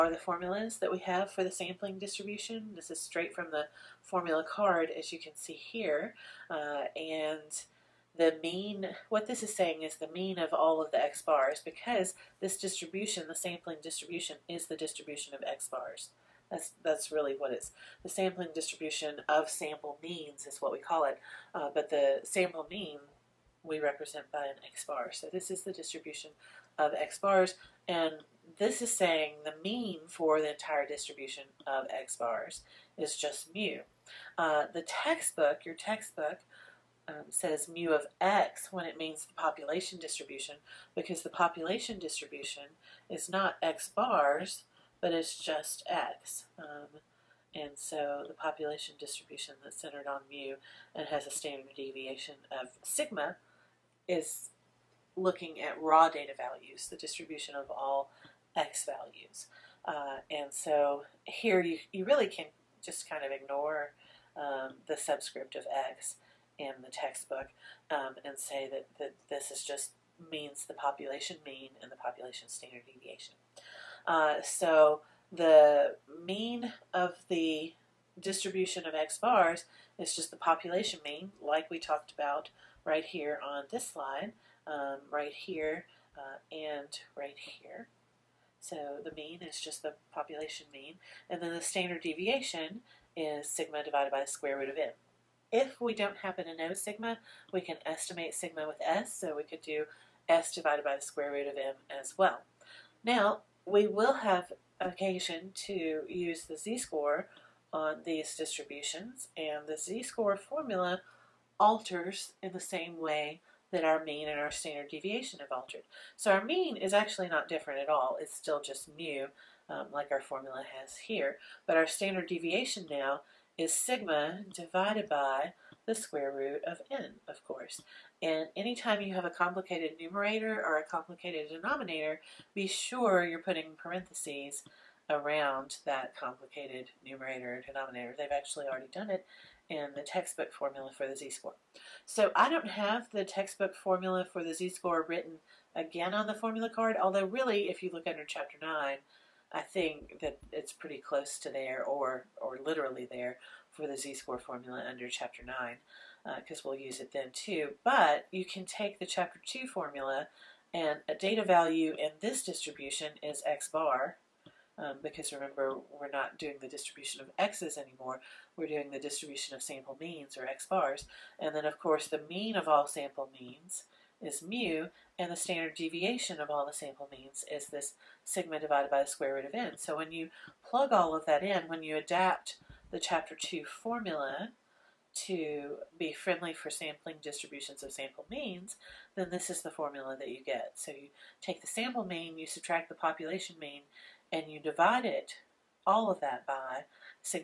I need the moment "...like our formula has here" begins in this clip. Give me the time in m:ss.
1:59.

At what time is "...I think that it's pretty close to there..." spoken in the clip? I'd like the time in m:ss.
2:29.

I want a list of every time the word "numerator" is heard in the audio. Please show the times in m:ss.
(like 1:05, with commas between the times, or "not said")
2:09, 2:17.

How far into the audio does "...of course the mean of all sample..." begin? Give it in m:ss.
2:51.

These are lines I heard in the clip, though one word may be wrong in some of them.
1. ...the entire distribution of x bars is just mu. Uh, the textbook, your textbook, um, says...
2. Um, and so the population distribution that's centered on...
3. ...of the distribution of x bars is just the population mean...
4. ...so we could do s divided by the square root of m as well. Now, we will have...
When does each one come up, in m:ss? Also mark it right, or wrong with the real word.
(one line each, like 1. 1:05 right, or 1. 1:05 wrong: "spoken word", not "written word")
1. 0:30 right
2. 0:46 right
3. 1:16 right
4. 1:39 right.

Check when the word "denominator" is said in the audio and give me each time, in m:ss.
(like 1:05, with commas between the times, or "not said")
2:11, 2:17.